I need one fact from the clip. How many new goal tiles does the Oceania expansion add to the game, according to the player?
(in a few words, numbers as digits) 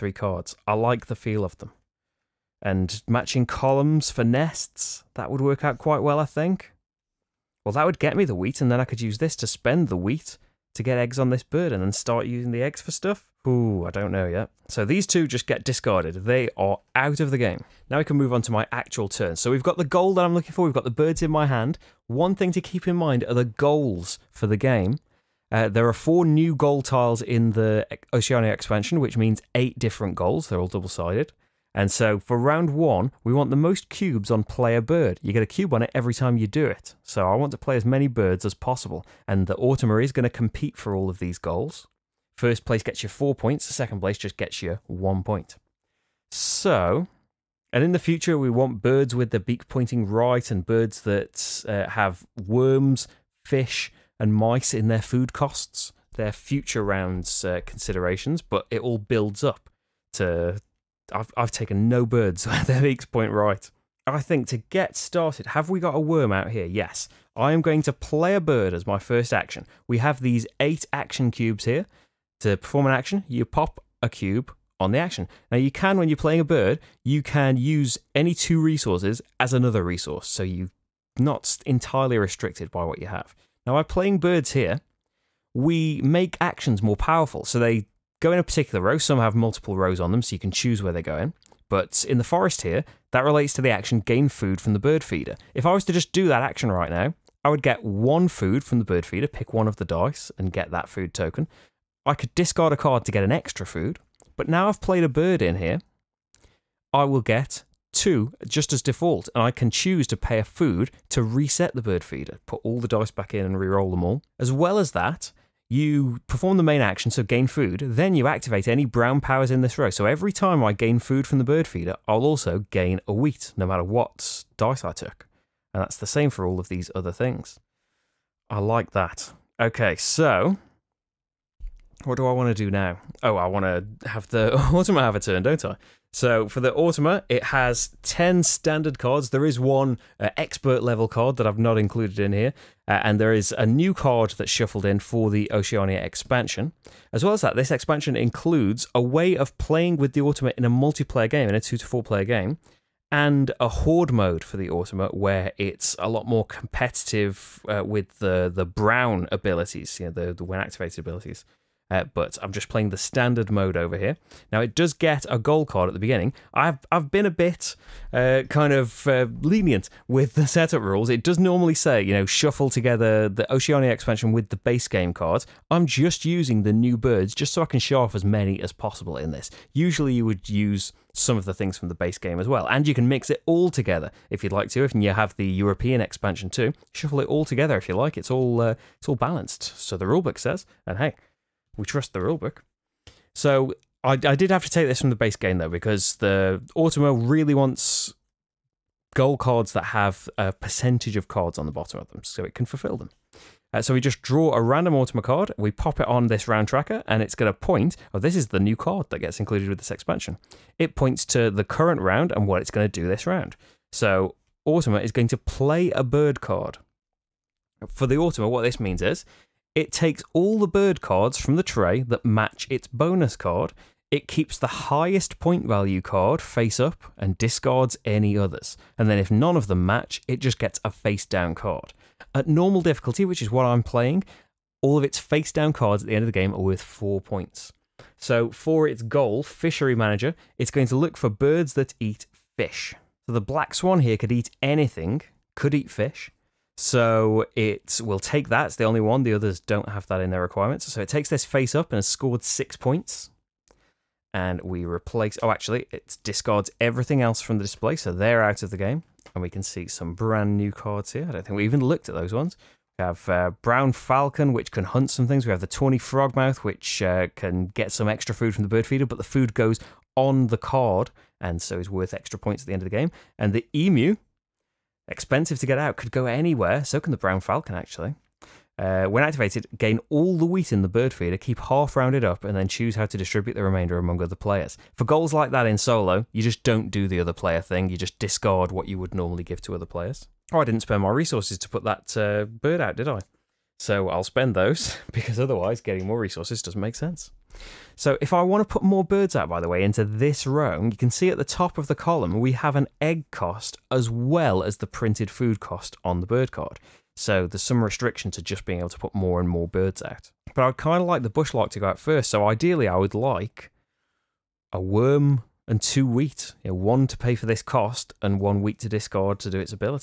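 4.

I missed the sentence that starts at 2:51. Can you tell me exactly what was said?
It does normally say you know shuffle together the Oceania expansion with the base game cards.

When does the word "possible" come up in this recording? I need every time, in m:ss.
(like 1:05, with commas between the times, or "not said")
0:38, 2:58.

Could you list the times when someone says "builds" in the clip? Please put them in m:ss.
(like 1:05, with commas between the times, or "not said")
0:58.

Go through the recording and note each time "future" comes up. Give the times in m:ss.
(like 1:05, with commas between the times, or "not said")
0:47, 0:56.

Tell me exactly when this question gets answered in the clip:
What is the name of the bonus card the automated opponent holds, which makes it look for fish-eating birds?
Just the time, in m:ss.
3:59.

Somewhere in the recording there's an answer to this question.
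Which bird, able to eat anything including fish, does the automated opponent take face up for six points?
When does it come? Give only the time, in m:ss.
4:03.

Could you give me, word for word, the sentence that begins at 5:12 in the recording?
So ideally, I would like a worm and two wheat.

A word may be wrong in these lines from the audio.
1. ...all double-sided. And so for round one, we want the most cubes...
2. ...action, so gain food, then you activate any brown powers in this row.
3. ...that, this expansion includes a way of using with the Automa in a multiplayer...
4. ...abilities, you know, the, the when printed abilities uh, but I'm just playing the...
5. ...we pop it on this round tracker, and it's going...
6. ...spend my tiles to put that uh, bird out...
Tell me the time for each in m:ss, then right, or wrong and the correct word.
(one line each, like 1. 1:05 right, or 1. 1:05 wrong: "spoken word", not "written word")
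1. 0:30 right
2. 1:56 right
3. 2:27 wrong: "playing", not "using"
4. 2:39 wrong: "activated", not "printed"
5. 3:25 right
6. 4:50 wrong: "resources", not "tiles".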